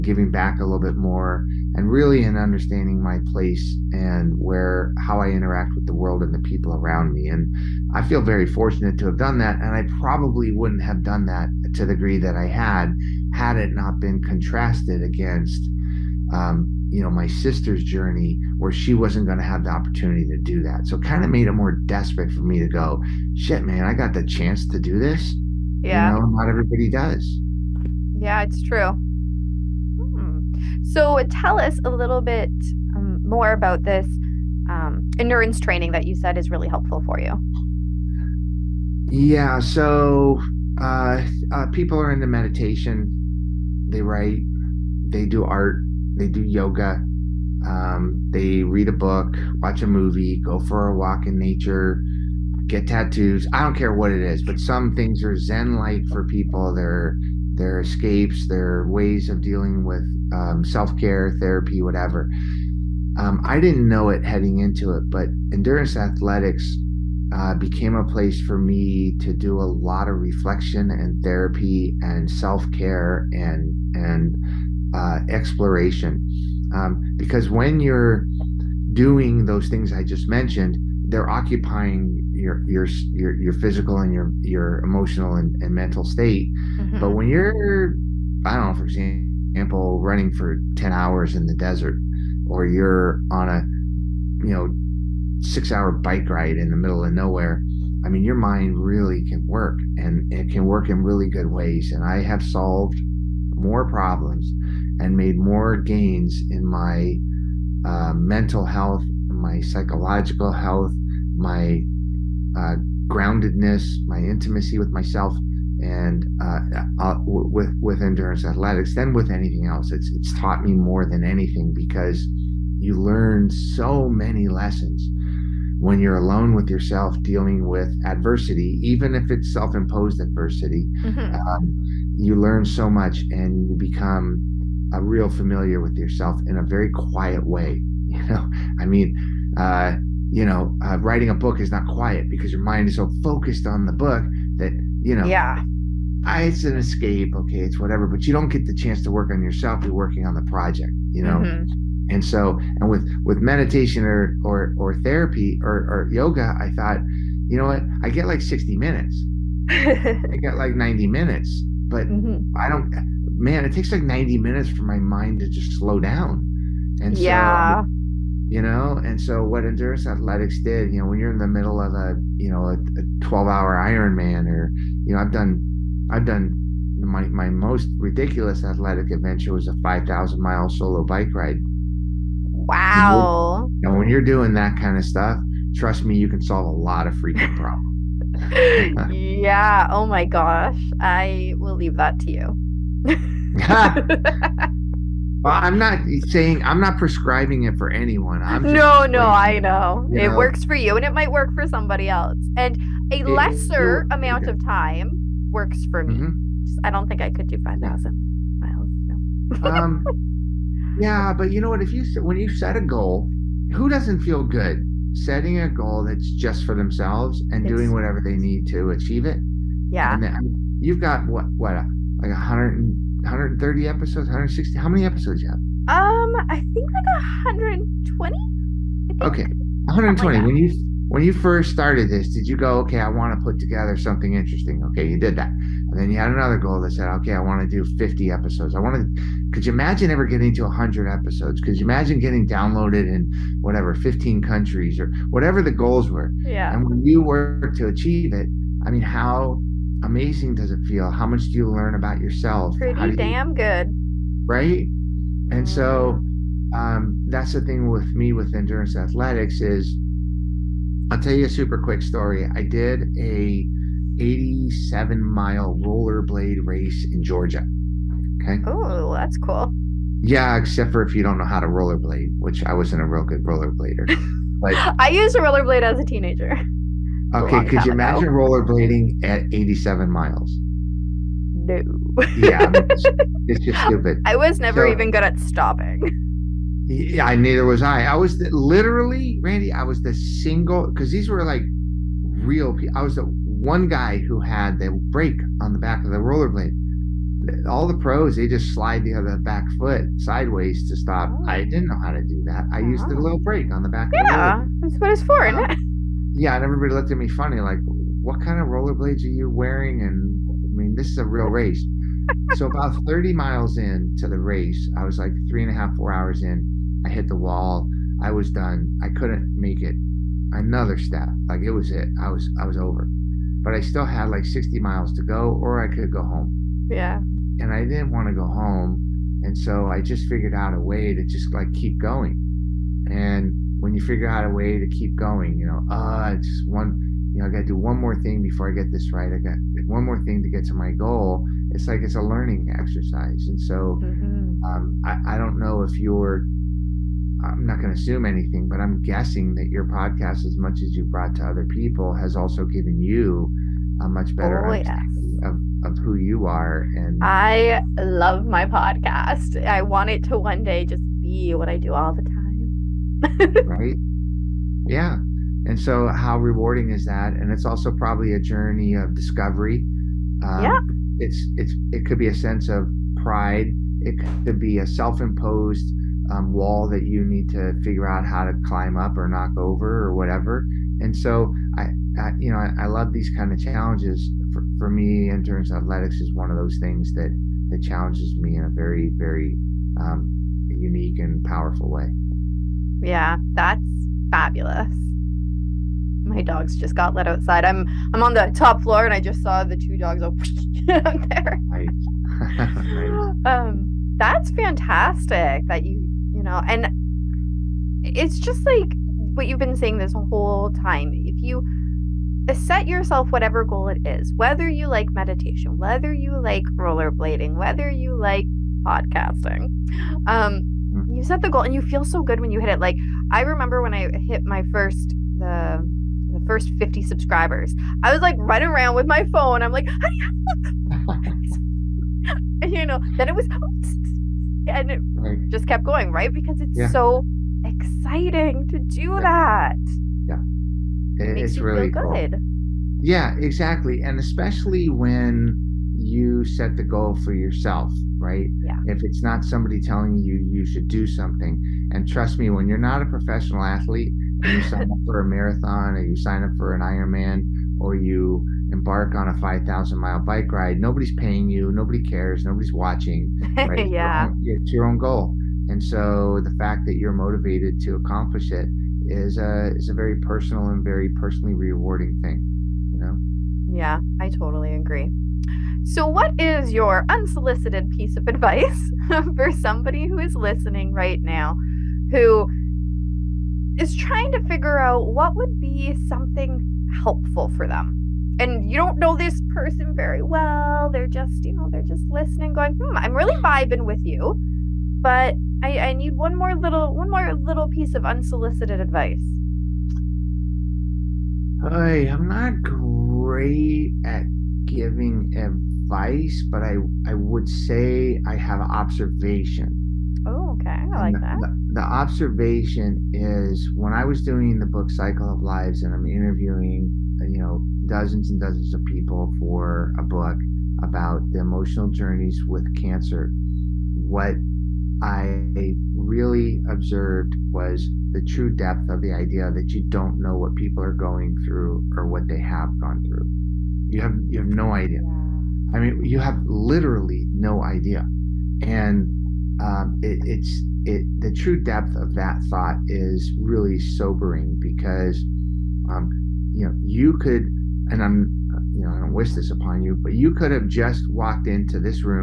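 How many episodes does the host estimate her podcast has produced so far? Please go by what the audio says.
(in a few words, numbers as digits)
120.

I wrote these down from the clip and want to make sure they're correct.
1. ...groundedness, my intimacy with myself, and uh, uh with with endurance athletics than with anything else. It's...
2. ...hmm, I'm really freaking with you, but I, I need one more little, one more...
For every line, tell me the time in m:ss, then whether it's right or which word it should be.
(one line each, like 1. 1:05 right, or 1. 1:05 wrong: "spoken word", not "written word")
1. 1:53 right
2. 8:12 wrong: "vibing", not "freaking".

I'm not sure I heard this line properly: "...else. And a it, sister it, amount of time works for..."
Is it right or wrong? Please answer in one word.
wrong.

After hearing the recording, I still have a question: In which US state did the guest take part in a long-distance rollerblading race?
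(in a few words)
Georgia.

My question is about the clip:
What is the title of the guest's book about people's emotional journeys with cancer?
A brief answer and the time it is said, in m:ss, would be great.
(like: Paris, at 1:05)
Cycle of Lives, at 8:34.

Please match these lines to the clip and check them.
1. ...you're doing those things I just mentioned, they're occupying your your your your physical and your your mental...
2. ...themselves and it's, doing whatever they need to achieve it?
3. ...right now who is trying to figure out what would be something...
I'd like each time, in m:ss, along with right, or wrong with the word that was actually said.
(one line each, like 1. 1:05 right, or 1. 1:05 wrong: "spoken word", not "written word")
1. 1:17 wrong: "emotional", not "mental"
2. 3:36 right
3. 8:00 right.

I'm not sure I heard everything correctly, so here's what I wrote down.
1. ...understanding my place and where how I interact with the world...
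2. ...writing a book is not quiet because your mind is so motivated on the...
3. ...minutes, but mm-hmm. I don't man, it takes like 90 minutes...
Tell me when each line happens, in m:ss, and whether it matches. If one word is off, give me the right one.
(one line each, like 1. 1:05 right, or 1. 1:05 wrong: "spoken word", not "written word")
1. 0:02 right
2. 2:20 wrong: "focused", not "motivated"
3. 2:41 right.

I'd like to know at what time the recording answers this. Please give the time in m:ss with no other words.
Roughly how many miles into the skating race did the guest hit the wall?
5:12.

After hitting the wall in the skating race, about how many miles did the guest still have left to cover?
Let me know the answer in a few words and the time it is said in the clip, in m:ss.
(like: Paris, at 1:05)
60, at 5:24.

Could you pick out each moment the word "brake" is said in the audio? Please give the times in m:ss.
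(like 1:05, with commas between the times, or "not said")
4:54, 5:03.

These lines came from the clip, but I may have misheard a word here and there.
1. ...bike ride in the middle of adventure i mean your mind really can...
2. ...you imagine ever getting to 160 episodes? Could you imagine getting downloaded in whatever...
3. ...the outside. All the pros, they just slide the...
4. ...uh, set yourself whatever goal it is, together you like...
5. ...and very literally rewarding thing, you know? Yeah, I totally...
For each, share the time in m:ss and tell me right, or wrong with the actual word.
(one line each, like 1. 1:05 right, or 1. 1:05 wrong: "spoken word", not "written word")
1. 1:35 wrong: "nowhere", not "adventure"
2. 3:59 wrong: "100", not "160"
3. 4:56 wrong: "rollerblade", not "outside"
4. 6:52 wrong: "whether", not "together"
5. 7:50 wrong: "personally", not "literally".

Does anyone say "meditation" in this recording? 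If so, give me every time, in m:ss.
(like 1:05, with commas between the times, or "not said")
0:42, 2:33, 6:55.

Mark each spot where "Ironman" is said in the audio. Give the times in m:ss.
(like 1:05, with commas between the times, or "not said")
2:53, 7:36.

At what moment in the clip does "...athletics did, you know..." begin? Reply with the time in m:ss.
2:50.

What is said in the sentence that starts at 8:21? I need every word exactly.
Hey, I'm not great at giving advice, but I I would say I have observation.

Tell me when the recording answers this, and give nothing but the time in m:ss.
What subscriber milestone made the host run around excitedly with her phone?
7:06.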